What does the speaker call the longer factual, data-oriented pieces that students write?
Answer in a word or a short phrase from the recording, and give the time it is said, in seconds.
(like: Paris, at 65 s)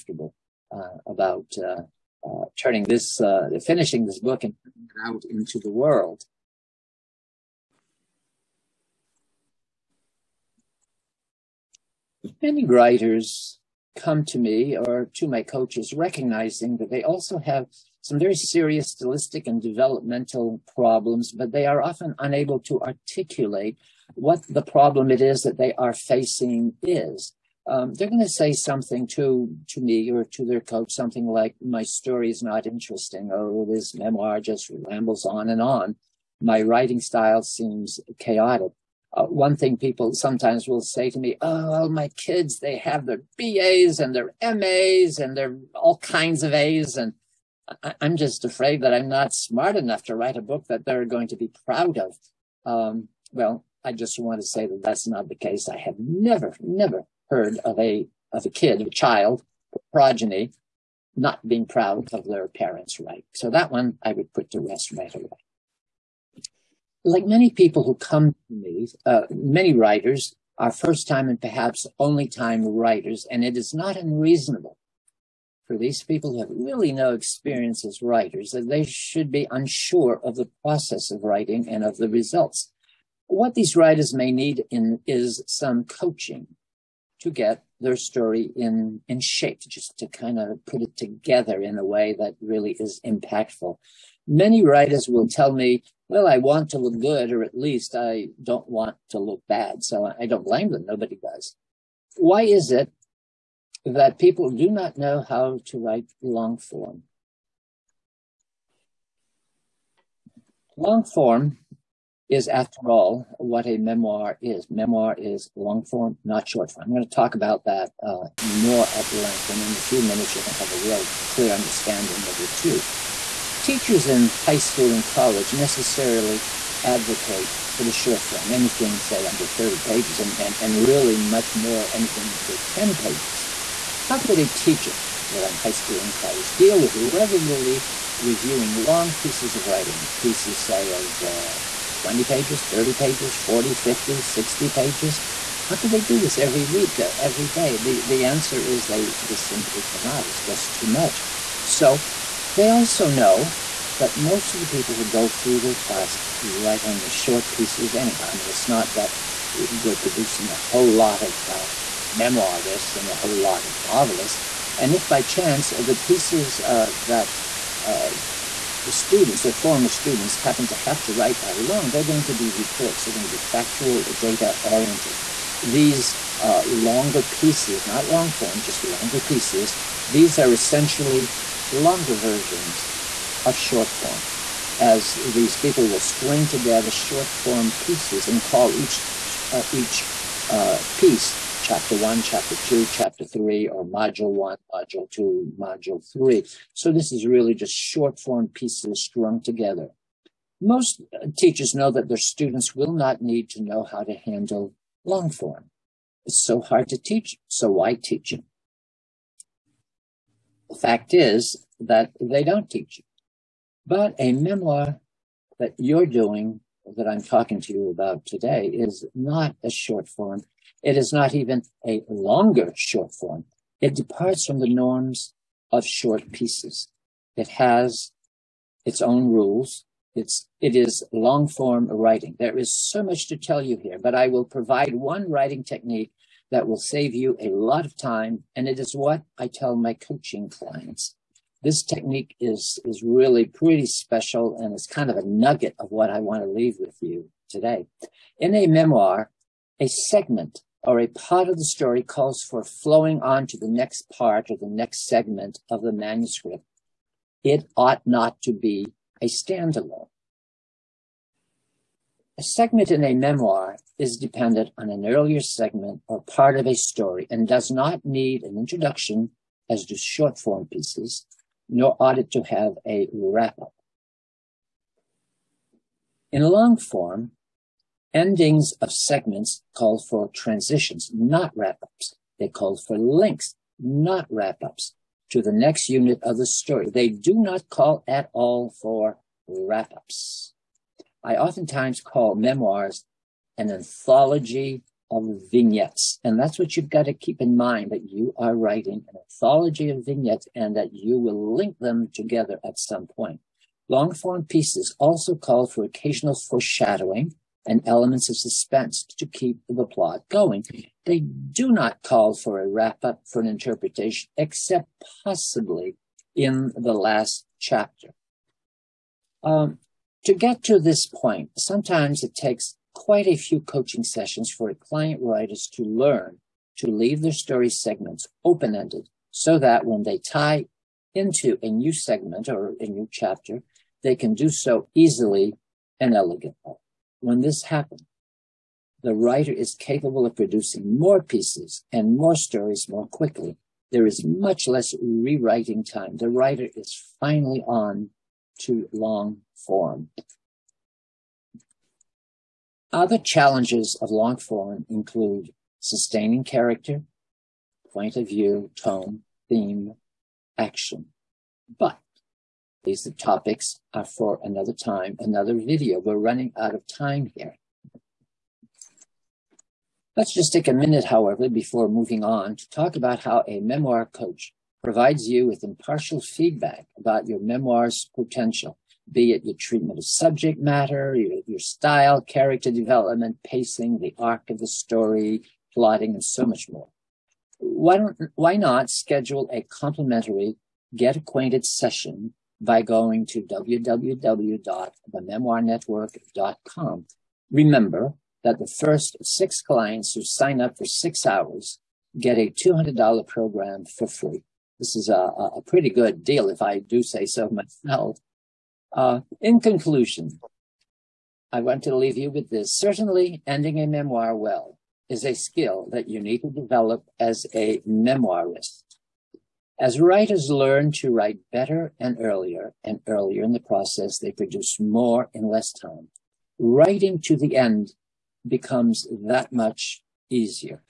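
reports, at 172 s.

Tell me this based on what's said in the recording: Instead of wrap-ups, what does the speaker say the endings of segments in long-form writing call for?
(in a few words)
transitions.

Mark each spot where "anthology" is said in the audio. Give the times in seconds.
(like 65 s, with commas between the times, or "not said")
293 s, 299 s.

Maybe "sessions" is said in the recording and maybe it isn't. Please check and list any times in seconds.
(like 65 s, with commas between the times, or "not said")
324 s, 391 s.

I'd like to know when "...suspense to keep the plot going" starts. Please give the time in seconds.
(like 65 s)
308 s.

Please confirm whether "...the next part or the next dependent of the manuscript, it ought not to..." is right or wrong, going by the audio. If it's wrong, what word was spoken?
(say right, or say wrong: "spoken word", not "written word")
wrong: "segment", not "dependent".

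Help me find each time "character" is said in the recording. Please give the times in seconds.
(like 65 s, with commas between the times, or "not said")
356 s, 382 s.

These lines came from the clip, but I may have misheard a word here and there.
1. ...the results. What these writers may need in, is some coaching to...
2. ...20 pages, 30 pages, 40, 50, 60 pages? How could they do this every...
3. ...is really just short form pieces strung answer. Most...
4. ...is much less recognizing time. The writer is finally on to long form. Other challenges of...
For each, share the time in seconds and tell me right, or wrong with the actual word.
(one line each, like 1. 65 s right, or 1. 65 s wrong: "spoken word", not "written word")
1. 81 s right
2. 142 s right
3. 197 s wrong: "together", not "answer"
4. 344 s wrong: "rewriting", not "recognizing".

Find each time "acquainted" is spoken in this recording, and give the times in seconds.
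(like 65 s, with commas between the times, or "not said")
391 s.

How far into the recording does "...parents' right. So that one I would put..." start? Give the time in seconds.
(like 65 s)
62 s.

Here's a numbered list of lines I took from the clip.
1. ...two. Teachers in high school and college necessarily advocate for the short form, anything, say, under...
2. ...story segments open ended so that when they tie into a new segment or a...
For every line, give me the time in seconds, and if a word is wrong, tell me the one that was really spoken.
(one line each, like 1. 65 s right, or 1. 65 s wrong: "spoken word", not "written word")
1. 122 s right
2. 327 s right.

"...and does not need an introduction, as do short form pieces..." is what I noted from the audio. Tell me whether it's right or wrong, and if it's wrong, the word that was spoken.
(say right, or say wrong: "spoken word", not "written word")
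right.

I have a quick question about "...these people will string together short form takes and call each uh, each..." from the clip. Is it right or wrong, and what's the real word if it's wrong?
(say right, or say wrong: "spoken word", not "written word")
wrong: "pieces", not "takes".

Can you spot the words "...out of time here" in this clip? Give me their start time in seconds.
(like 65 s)
366 s.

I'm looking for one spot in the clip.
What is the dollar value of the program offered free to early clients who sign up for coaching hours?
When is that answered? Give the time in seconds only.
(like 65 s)
402 s.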